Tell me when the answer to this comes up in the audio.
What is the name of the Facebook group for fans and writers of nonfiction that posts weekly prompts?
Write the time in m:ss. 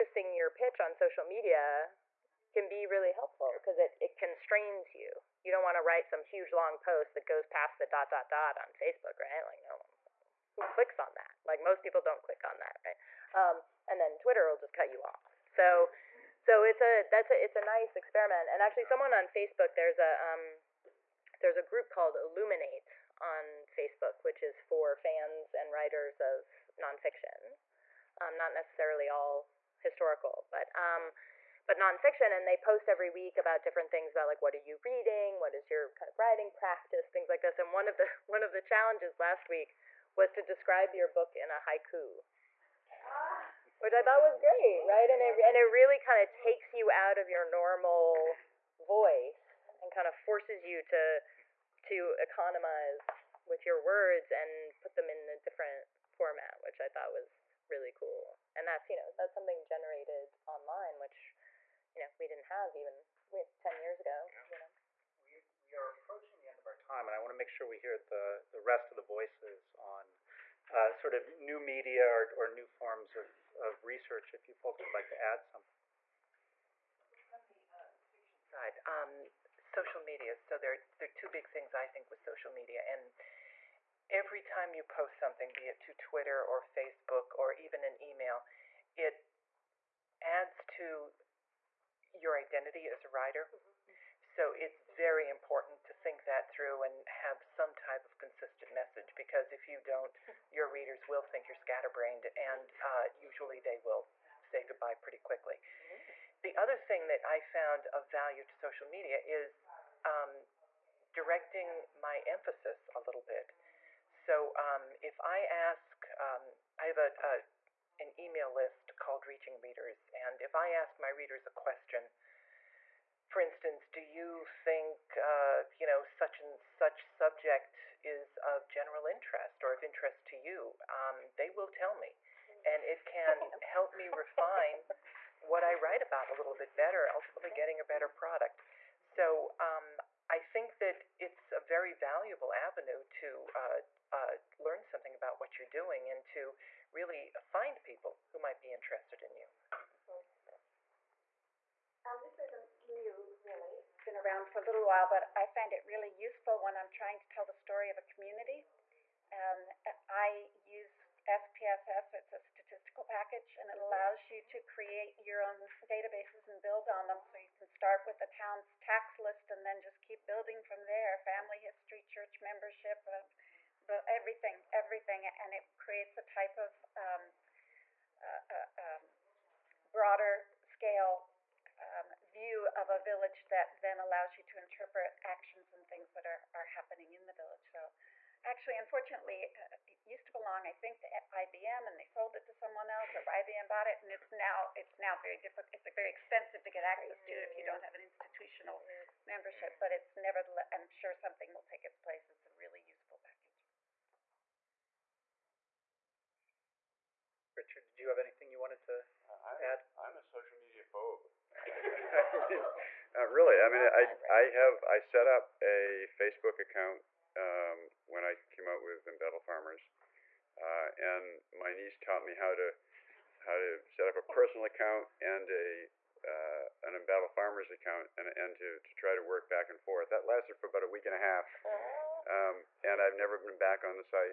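0:22.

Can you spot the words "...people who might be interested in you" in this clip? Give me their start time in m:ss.
2:27.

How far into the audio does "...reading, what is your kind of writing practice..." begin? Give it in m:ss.
0:34.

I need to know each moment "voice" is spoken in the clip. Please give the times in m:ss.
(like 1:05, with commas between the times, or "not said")
0:48, 1:09.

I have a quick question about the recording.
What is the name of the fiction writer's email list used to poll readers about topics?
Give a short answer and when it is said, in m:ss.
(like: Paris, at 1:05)
Reaching Readers, at 1:59.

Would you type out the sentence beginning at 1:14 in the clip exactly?
If you folks would like to add something.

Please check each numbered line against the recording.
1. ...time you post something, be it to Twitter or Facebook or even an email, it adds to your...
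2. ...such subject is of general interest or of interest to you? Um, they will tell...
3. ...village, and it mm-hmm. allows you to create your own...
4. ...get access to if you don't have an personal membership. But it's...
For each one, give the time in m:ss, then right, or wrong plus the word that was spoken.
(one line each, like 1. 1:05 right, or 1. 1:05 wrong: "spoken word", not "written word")
1. 1:24 right
2. 2:06 right
3. 2:43 wrong: "package", not "village"
4. 3:16 wrong: "institutional", not "personal".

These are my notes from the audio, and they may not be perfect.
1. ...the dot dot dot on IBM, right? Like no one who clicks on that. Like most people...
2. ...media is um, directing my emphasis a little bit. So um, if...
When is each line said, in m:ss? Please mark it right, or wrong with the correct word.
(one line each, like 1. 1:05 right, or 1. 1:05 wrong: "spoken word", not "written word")
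1. 0:07 wrong: "Facebook", not "IBM"
2. 1:48 right.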